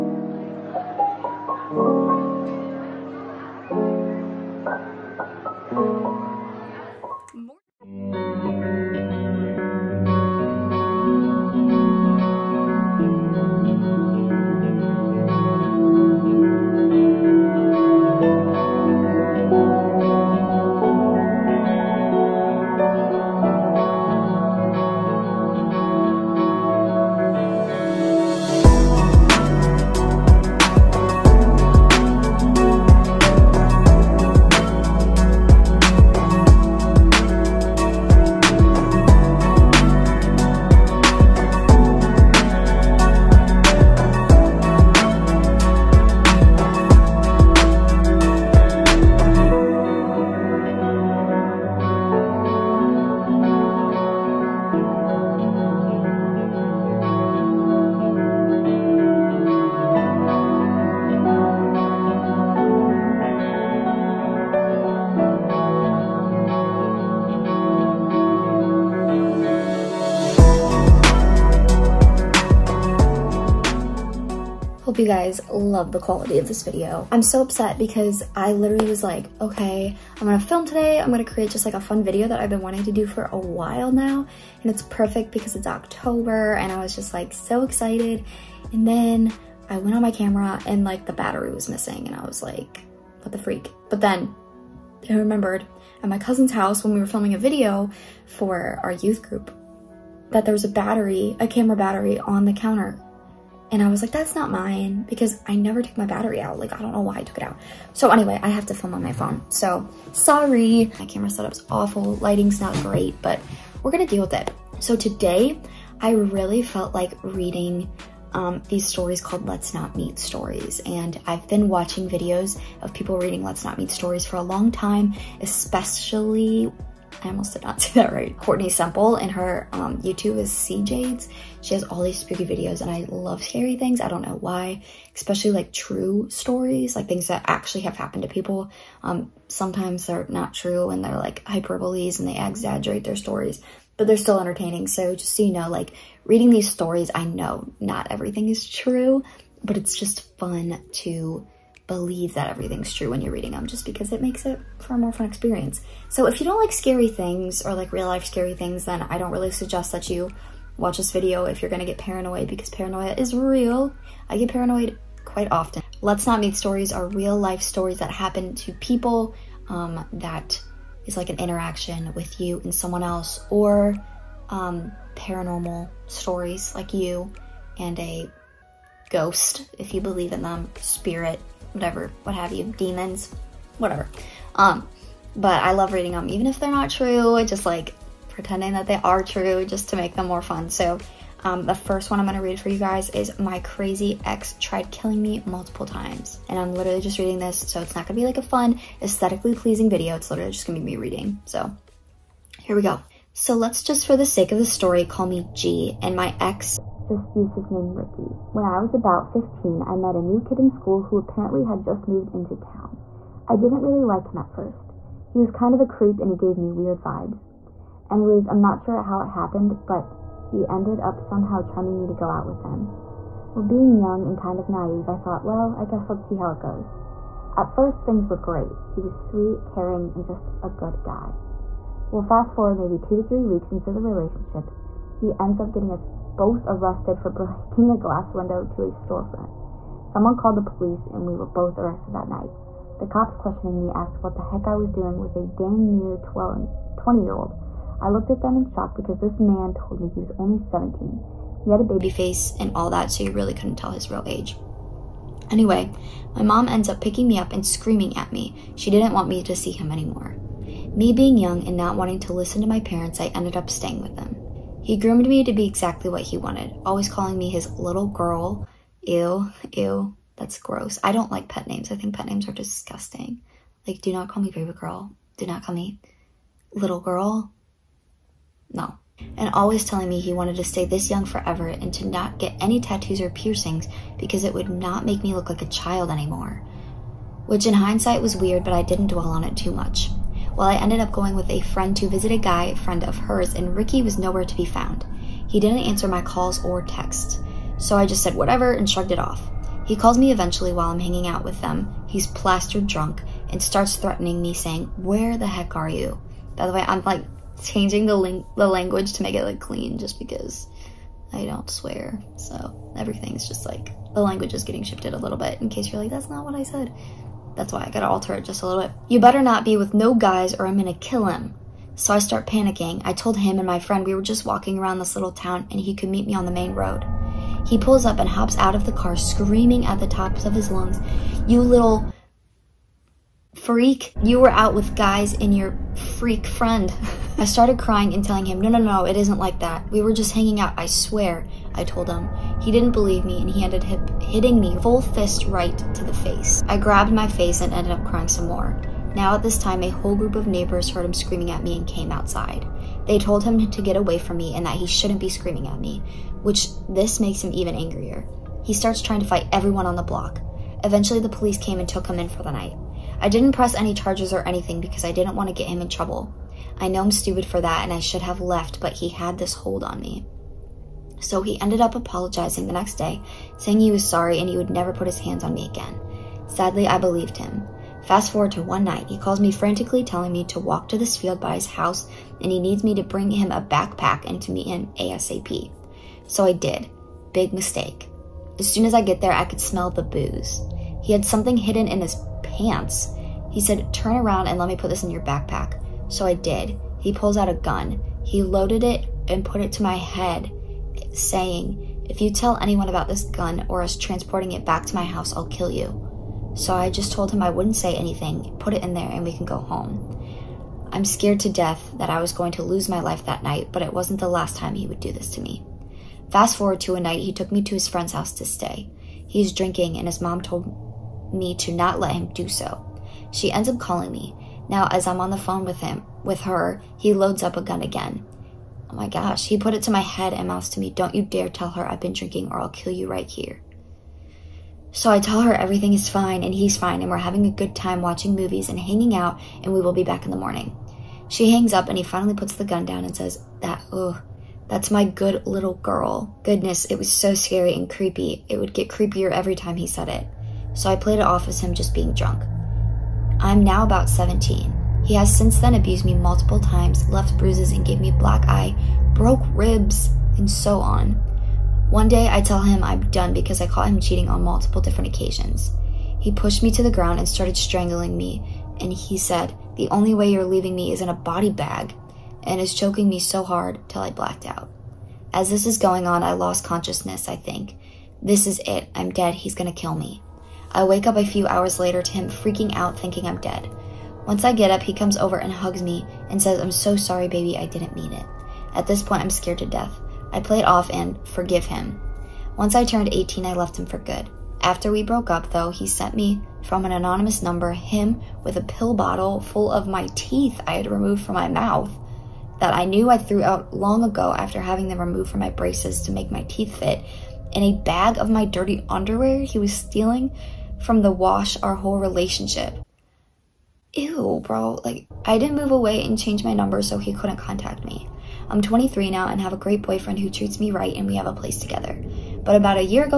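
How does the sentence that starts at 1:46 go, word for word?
Like, I don't know why I took it out.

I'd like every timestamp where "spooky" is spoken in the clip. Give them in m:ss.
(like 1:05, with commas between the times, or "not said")
2:12.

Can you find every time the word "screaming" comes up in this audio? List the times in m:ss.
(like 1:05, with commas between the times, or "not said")
4:17, 5:29, 5:51, 5:55.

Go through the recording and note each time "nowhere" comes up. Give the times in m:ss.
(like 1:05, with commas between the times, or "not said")
4:54.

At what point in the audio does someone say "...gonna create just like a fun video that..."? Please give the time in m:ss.
1:21.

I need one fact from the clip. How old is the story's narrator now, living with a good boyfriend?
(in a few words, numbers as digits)
23.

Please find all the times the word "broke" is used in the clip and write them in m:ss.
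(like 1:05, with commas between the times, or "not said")
7:39, 8:15.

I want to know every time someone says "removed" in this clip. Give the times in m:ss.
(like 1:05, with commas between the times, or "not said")
8:20, 8:24.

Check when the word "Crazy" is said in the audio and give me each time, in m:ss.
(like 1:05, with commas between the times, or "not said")
3:13.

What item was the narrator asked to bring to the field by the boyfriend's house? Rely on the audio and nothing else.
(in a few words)
a backpack.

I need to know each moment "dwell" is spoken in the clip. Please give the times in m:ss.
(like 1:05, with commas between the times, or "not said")
4:49.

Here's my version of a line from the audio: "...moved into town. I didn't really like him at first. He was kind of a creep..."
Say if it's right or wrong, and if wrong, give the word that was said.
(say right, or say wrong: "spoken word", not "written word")
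right.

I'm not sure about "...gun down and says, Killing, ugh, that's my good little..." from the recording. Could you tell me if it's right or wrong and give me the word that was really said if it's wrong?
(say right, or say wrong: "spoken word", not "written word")
wrong: "That", not "Killing".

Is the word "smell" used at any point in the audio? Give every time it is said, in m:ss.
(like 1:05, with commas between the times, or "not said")
6:29.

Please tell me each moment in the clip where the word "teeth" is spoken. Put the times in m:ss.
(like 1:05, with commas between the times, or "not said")
8:20, 8:26.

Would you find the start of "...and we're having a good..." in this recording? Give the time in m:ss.
7:17.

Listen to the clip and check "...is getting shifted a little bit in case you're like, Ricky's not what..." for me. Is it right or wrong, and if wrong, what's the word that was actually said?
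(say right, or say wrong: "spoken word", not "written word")
wrong: "That", not "Ricky".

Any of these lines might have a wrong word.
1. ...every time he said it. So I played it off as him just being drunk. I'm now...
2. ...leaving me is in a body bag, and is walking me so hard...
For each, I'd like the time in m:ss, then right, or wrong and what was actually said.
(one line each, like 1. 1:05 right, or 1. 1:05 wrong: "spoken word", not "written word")
1. 7:29 right
2. 7:50 wrong: "choking", not "walking".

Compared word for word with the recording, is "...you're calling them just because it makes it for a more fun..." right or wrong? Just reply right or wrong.
wrong.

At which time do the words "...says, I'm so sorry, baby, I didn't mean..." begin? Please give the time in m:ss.
8:06.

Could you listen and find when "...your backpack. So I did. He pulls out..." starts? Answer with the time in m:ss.
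6:35.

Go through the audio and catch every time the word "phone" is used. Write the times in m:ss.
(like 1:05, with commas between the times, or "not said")
1:49, 7:05.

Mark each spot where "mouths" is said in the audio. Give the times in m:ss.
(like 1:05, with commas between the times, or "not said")
7:10, 8:21.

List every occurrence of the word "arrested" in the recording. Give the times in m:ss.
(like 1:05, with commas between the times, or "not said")
3:56, 4:01.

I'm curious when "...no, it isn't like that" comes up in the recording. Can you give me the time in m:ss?
5:38.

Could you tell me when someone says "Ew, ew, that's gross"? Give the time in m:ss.
4:29.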